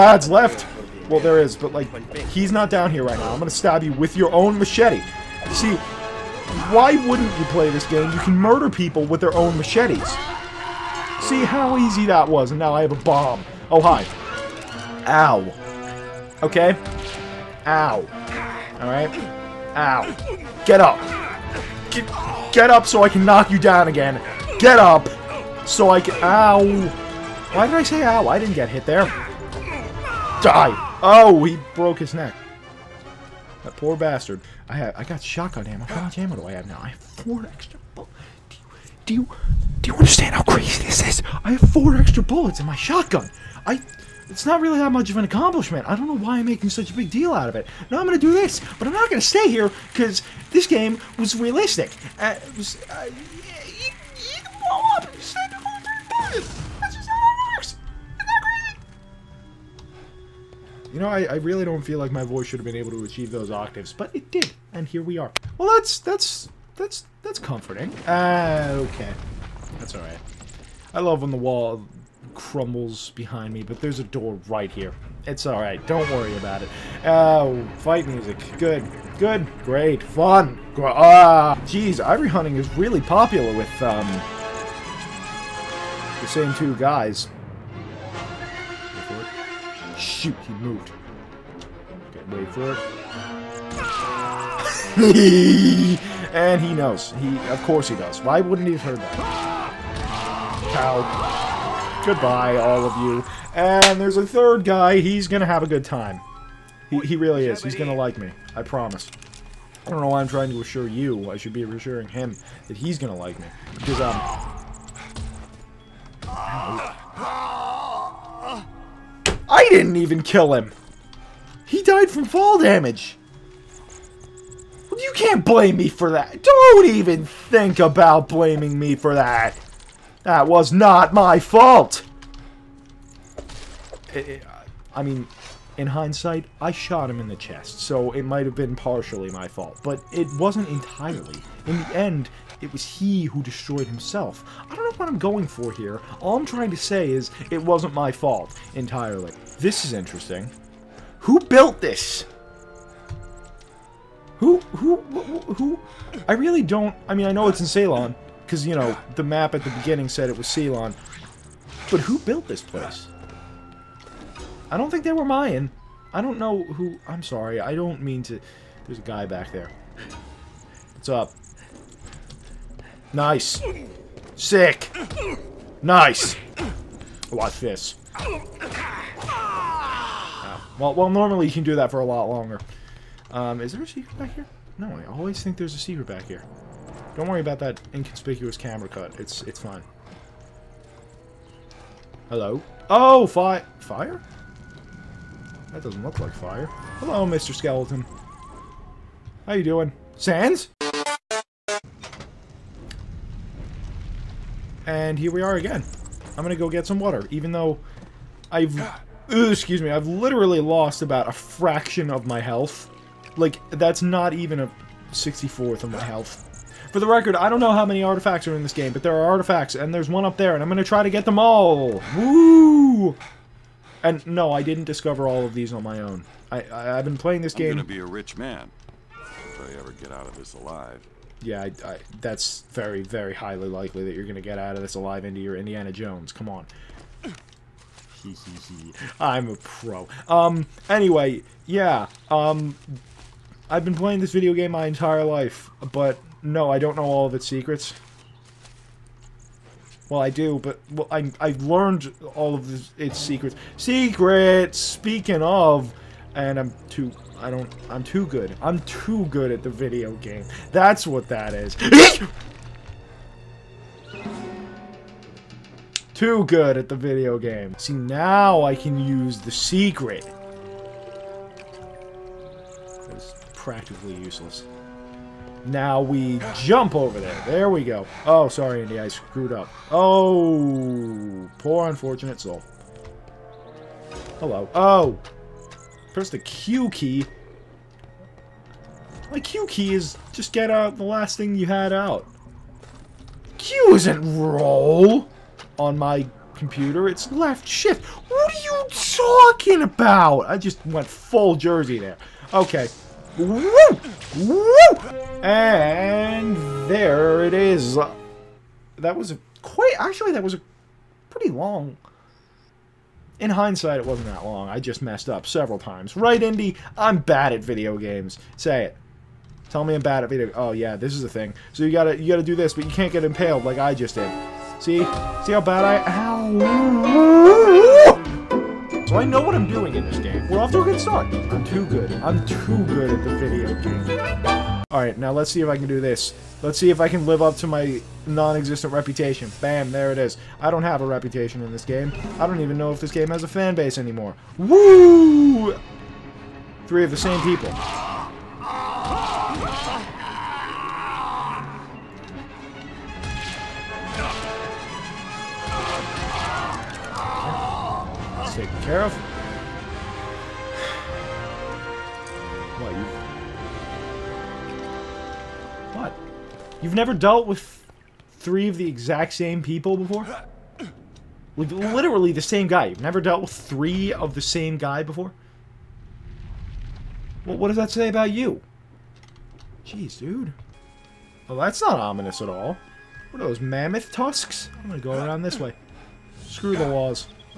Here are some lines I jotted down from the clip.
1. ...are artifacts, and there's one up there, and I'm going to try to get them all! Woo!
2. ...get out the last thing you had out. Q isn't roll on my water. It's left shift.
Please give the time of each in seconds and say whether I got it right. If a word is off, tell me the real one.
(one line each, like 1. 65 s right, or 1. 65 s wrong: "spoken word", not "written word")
1. 219 s right
2. 290 s wrong: "computer", not "water".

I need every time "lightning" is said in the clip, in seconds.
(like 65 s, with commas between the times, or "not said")
not said.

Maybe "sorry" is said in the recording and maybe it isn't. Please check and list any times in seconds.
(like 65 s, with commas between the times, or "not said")
167 s, 278 s.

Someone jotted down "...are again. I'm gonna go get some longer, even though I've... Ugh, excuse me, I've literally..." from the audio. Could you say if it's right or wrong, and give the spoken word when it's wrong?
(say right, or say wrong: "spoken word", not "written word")
wrong: "water", not "longer".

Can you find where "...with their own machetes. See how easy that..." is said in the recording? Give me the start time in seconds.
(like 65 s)
9 s.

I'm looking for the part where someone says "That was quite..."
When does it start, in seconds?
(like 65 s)
308 s.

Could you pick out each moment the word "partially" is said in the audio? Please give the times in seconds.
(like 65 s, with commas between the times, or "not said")
138 s.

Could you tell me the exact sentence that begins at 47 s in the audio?
Now I'm going to do this, but I'm not going to stay here because this game was realistic.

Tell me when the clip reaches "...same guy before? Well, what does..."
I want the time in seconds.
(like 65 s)
374 s.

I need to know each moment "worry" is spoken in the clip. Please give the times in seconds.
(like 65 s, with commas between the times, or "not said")
76 s, 187 s.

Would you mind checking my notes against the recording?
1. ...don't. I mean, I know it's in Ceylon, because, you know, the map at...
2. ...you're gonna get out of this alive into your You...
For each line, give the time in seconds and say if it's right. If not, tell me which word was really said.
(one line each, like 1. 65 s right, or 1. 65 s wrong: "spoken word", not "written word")
1. 156 s right
2. 234 s wrong: "Indiana", not "You".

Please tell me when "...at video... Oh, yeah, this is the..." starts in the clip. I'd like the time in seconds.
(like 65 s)
320 s.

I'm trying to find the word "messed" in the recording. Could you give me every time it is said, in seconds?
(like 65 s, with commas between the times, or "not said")
314 s.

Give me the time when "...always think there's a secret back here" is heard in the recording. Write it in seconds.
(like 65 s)
185 s.